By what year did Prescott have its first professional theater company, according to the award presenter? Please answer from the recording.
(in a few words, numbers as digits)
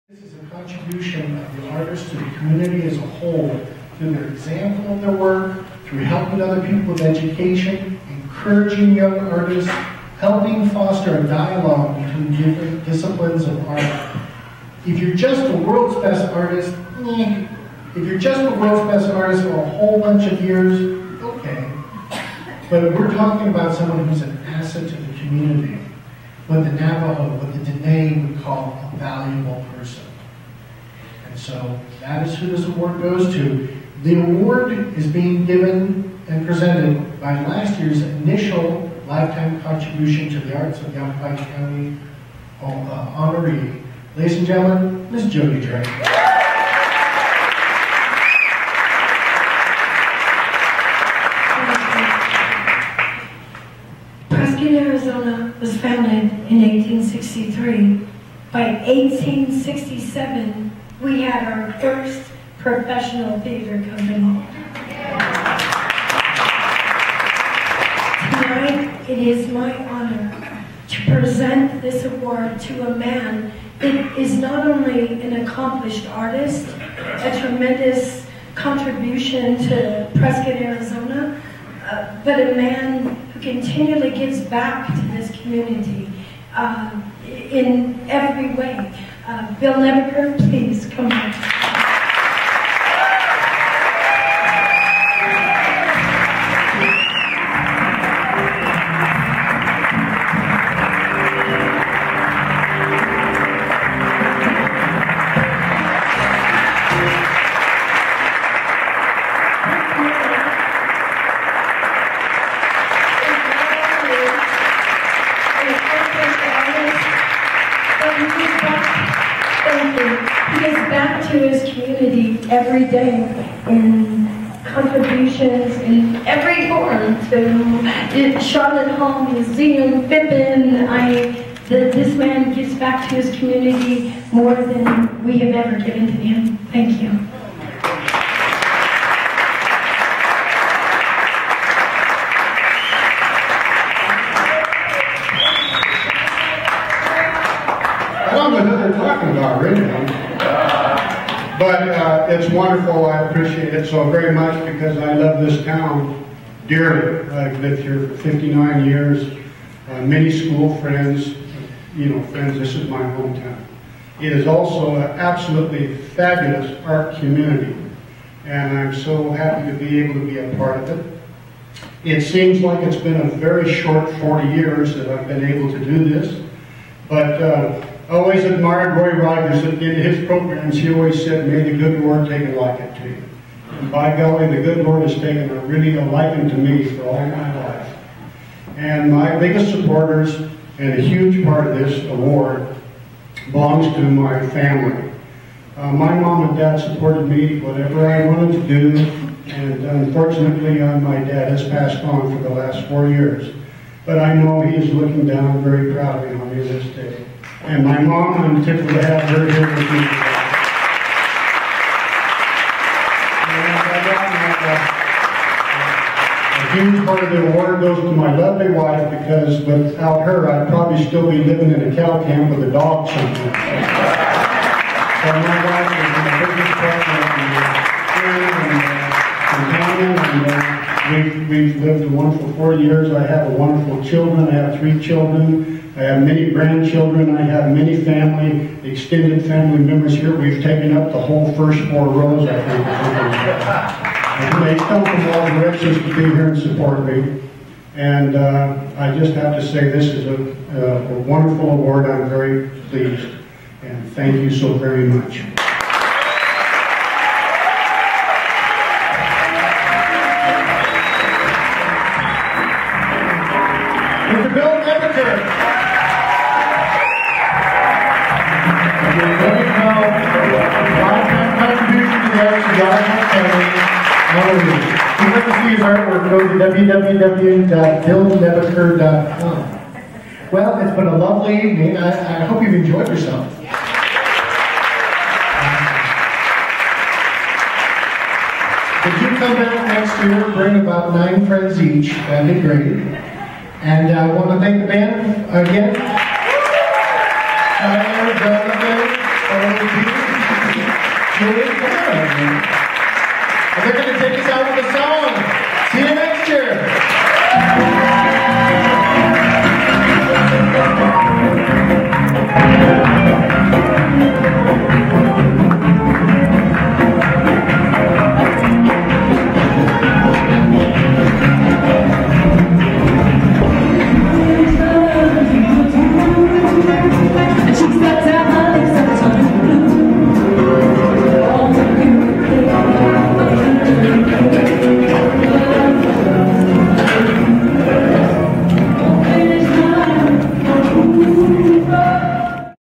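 1867.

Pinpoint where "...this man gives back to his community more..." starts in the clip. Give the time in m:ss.
2:11.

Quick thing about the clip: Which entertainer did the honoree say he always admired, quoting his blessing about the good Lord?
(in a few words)
Roy Rogers.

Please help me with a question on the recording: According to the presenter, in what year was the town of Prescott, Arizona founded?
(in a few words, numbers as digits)
1863.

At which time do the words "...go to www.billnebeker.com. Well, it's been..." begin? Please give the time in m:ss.
4:36.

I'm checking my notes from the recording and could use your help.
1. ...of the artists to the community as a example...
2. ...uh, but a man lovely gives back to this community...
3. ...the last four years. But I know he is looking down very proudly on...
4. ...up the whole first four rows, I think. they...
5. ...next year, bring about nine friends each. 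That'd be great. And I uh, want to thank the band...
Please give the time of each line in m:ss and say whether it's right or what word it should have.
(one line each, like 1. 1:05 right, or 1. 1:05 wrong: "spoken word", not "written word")
1. 0:01 wrong: "whole", not "example"
2. 1:21 wrong: "continually", not "lovely"
3. 3:22 right
4. 4:00 right
5. 4:49 right.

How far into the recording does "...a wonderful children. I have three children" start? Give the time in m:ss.
3:53.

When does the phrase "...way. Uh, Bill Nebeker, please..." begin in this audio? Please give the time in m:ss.
1:28.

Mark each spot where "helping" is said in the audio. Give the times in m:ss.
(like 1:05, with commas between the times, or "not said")
0:05, 0:10.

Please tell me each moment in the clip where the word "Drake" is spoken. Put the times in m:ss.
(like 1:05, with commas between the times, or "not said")
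0:45.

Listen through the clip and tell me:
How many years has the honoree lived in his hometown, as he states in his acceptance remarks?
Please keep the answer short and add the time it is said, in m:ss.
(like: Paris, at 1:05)
59, at 2:38.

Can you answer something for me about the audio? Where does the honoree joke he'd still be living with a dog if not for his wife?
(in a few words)
a cow camp.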